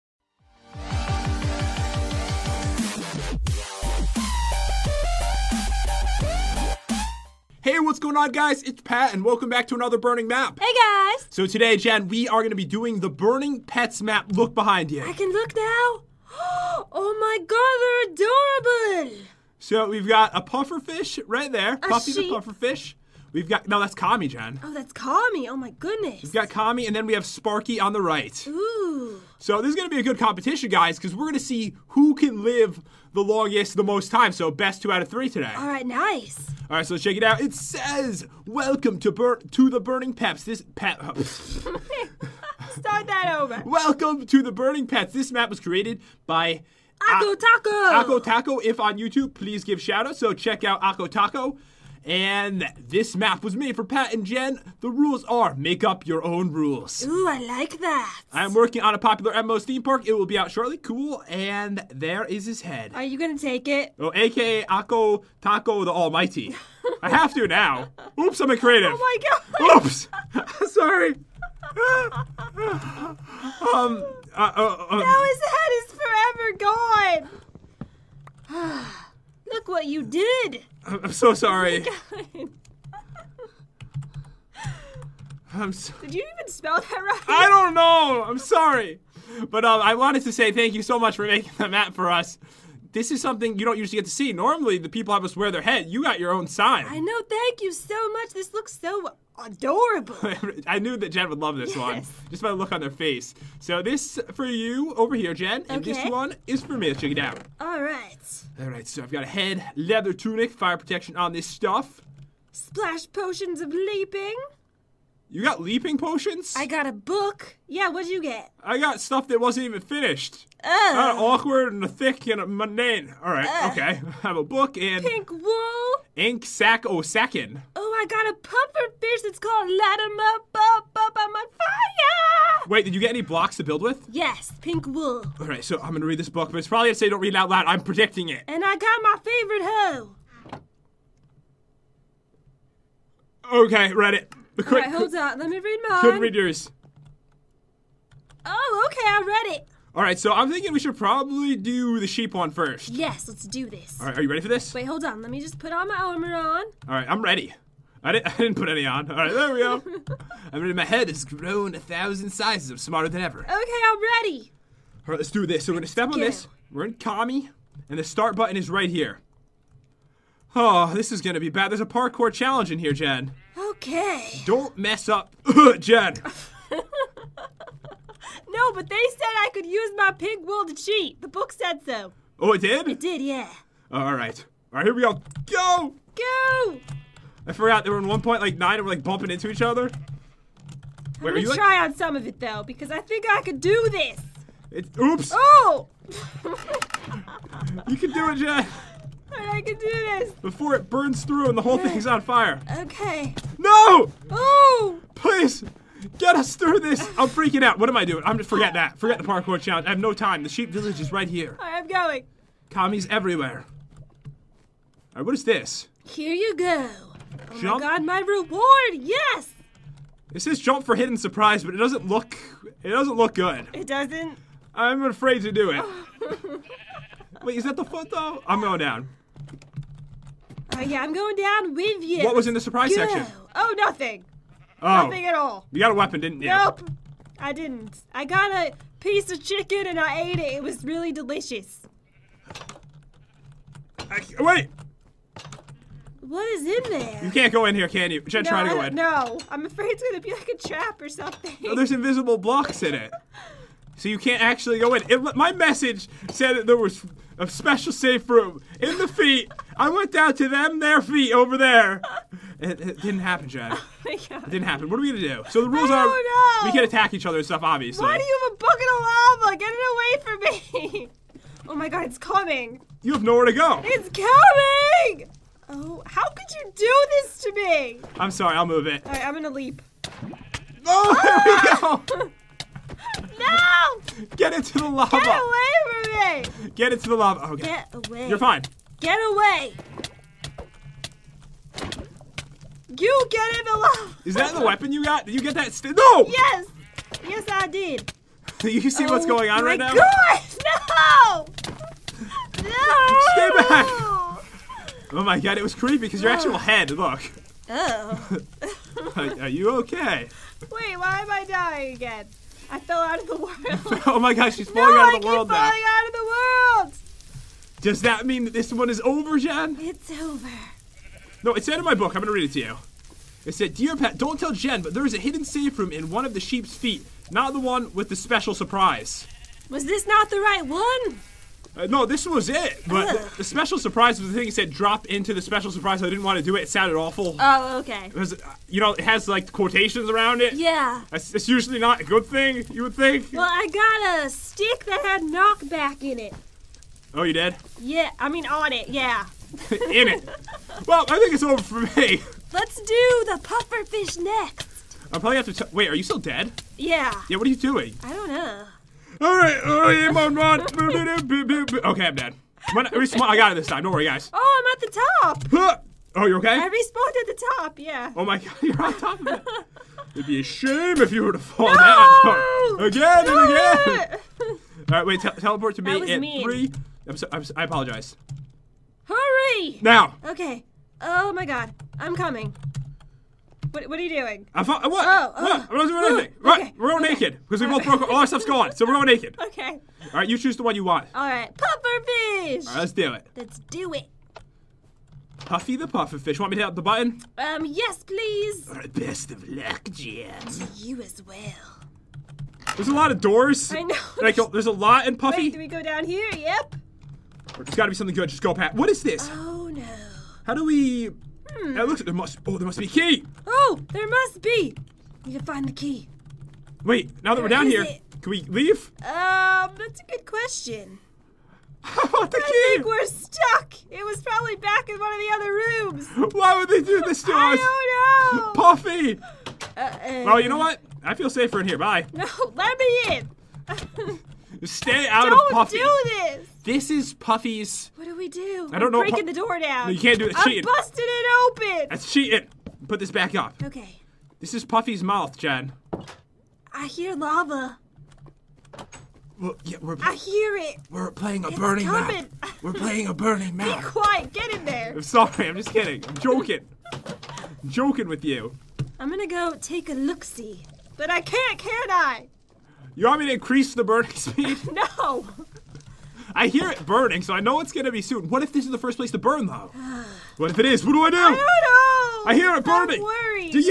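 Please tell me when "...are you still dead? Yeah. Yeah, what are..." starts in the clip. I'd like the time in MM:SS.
05:55.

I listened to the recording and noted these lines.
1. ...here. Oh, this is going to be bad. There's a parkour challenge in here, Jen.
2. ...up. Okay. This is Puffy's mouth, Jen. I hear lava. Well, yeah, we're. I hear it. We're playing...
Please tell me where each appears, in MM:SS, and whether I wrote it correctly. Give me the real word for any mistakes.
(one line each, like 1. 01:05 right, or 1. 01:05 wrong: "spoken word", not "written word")
1. 02:48 right
2. 07:23 right.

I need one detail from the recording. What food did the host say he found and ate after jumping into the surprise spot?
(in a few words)
Chicken.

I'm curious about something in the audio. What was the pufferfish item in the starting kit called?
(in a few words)
Light 'em up, up, up.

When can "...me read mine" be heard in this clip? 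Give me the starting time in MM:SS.
02:25.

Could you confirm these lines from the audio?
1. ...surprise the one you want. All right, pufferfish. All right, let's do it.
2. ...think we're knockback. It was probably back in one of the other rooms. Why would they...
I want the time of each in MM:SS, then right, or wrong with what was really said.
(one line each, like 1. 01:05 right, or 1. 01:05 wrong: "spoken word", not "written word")
1. 06:30 wrong: "choose", not "surprise"
2. 07:02 wrong: "stuck", not "knockback".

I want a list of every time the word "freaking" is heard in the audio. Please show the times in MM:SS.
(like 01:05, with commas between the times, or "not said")
03:27.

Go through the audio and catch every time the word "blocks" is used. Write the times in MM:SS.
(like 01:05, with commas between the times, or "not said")
02:13, 04:12.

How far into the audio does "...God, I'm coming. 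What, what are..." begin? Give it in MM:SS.
06:21.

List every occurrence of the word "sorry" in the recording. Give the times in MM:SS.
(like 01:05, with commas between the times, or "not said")
01:10, 01:21, 01:28, 04:38, 07:35.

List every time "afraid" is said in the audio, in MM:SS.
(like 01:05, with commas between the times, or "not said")
03:45, 04:09.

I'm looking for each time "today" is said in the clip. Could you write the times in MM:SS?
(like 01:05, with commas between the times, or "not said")
00:11, 00:35.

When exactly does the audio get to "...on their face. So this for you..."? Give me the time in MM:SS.
01:42.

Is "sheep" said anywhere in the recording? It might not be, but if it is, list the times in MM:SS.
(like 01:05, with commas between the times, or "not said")
00:22, 02:32, 03:30, 05:26.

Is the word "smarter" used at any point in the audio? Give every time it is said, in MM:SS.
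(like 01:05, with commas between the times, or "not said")
02:42.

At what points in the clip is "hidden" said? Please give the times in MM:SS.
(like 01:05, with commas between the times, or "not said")
03:40, 05:25.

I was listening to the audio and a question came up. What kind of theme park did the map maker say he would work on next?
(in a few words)
A popular MMO's theme park.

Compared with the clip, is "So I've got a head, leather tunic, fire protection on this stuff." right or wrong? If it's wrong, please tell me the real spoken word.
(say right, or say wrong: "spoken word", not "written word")
right.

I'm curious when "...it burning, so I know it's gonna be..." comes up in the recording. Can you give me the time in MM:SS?
07:46.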